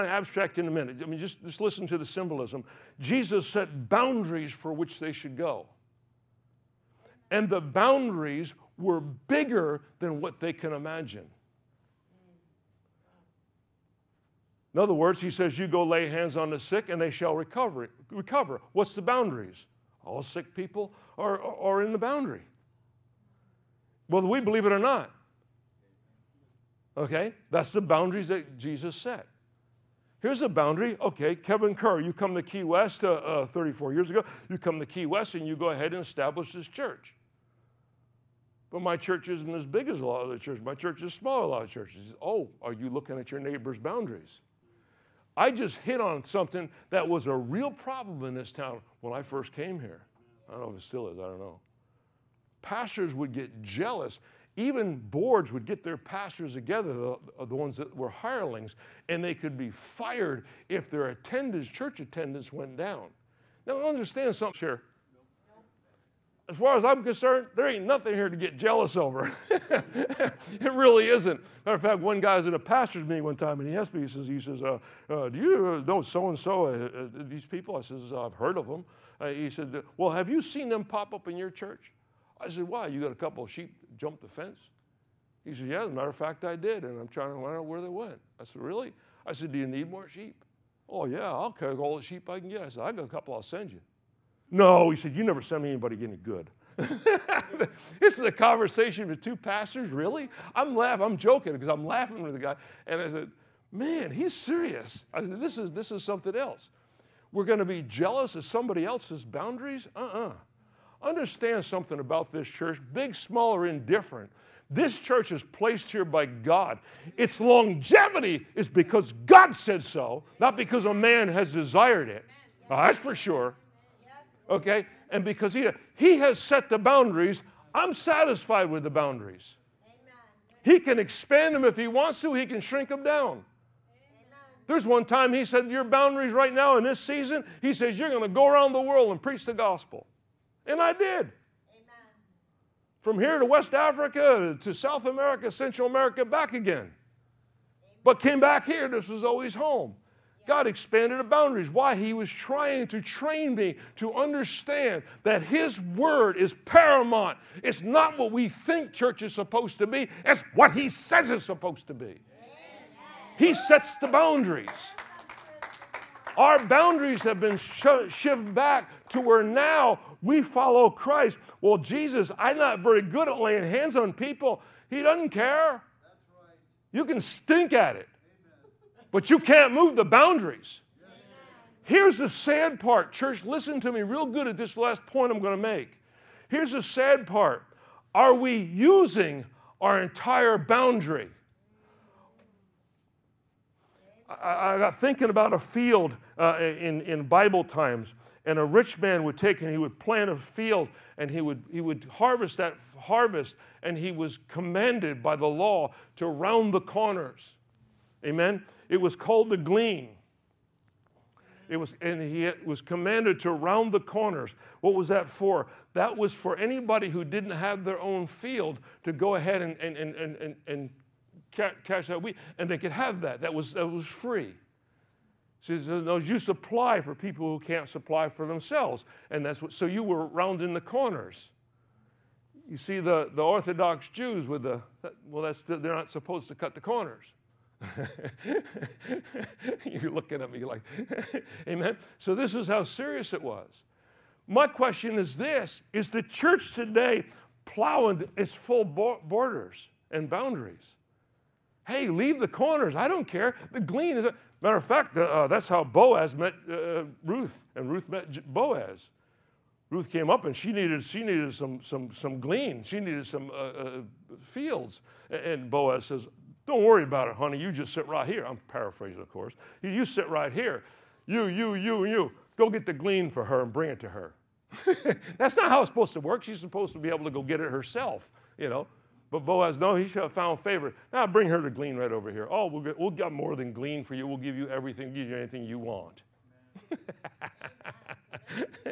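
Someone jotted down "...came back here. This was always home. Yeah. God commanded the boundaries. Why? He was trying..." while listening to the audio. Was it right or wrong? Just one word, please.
wrong.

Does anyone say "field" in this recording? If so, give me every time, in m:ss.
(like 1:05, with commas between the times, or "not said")
3:15, 3:20, 3:38, 4:24.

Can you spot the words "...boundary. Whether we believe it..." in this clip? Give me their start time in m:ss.
0:21.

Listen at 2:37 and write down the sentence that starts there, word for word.
It's not what we think church is supposed to be, it's what He says it's supposed to be.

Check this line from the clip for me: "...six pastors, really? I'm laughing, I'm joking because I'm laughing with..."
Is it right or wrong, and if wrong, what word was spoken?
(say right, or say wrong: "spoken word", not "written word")
wrong: "two", not "six".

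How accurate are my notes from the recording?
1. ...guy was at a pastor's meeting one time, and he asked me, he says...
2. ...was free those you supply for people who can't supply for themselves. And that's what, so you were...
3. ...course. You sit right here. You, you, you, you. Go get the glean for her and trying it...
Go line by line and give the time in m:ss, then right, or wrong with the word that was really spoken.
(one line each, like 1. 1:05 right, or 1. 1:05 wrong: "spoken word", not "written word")
1. 1:12 right
2. 3:43 right
3. 4:29 wrong: "bring", not "trying".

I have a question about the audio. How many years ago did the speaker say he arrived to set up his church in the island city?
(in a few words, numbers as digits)
34.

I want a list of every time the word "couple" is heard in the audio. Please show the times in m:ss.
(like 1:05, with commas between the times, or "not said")
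1:23, 1:33.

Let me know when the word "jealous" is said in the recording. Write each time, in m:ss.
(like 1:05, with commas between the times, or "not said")
0:53, 1:08, 1:47.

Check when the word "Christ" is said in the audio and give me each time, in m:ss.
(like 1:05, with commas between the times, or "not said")
2:50.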